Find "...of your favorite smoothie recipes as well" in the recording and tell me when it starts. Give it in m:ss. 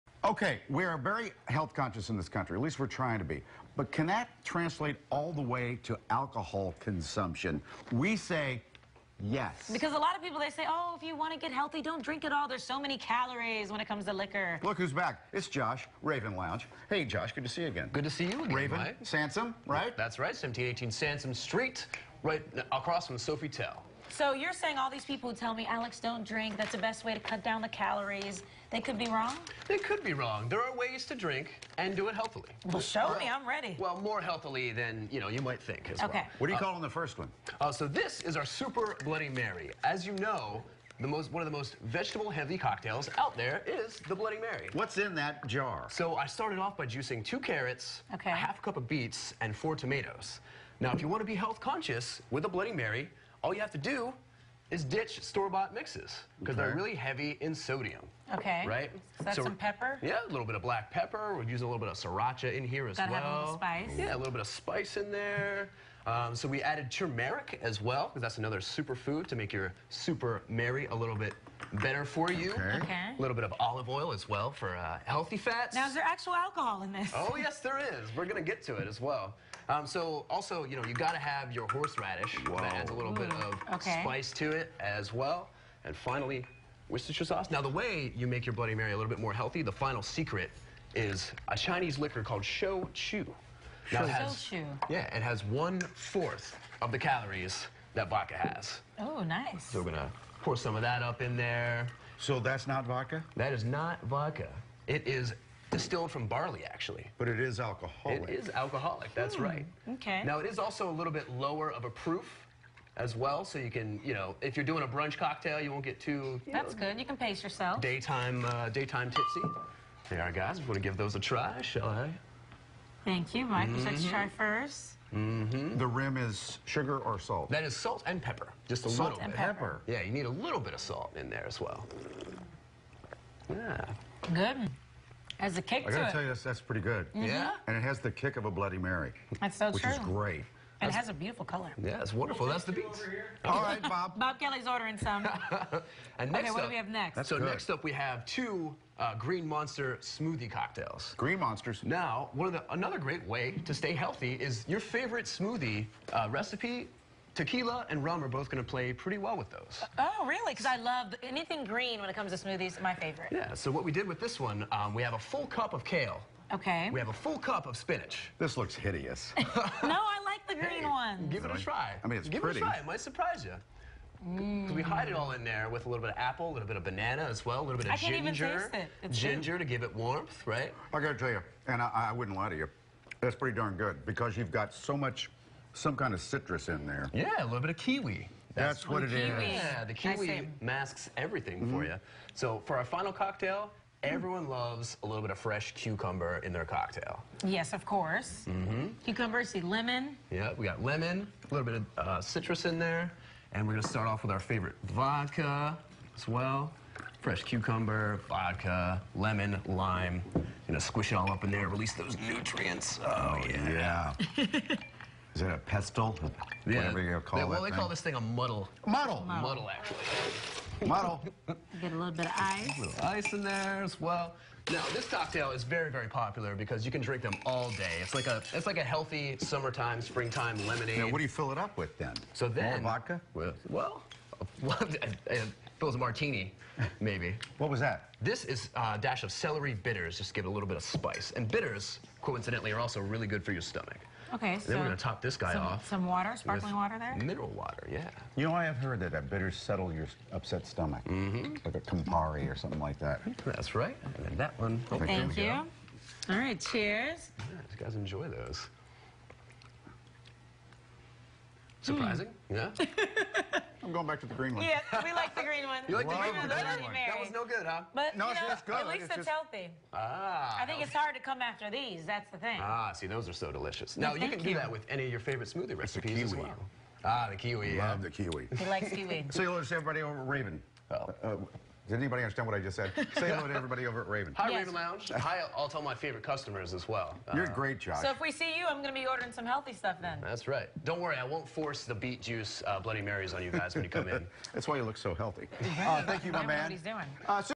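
4:35.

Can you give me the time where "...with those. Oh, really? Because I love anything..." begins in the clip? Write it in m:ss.
2:39.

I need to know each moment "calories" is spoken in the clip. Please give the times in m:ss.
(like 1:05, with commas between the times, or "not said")
0:12, 0:27, 1:36.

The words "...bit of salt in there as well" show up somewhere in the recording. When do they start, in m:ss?
2:10.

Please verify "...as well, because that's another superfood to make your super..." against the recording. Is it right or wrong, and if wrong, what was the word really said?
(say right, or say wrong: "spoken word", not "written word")
right.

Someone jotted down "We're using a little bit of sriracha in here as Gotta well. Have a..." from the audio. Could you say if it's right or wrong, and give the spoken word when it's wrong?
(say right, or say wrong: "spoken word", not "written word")
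right.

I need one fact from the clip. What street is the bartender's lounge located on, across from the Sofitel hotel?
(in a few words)
Sansom Street.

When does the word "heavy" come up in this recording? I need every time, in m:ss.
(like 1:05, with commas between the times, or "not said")
0:42, 0:56.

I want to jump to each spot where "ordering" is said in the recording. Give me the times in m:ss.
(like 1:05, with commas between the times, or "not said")
2:24, 4:49.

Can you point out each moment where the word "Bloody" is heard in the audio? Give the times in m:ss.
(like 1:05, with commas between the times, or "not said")
0:39, 0:44, 0:52, 1:28, 2:18, 4:52.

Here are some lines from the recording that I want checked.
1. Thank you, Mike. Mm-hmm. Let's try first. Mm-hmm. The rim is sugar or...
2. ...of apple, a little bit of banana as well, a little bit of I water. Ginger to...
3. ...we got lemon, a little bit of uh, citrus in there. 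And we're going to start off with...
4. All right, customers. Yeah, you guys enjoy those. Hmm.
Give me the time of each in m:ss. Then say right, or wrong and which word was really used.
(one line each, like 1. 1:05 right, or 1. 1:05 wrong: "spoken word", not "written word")
1. 2:03 right
2. 2:56 wrong: "ginger", not "water"
3. 3:20 right
4. 4:16 wrong: "cheers", not "customers".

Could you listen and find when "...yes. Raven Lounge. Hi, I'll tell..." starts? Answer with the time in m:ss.
4:44.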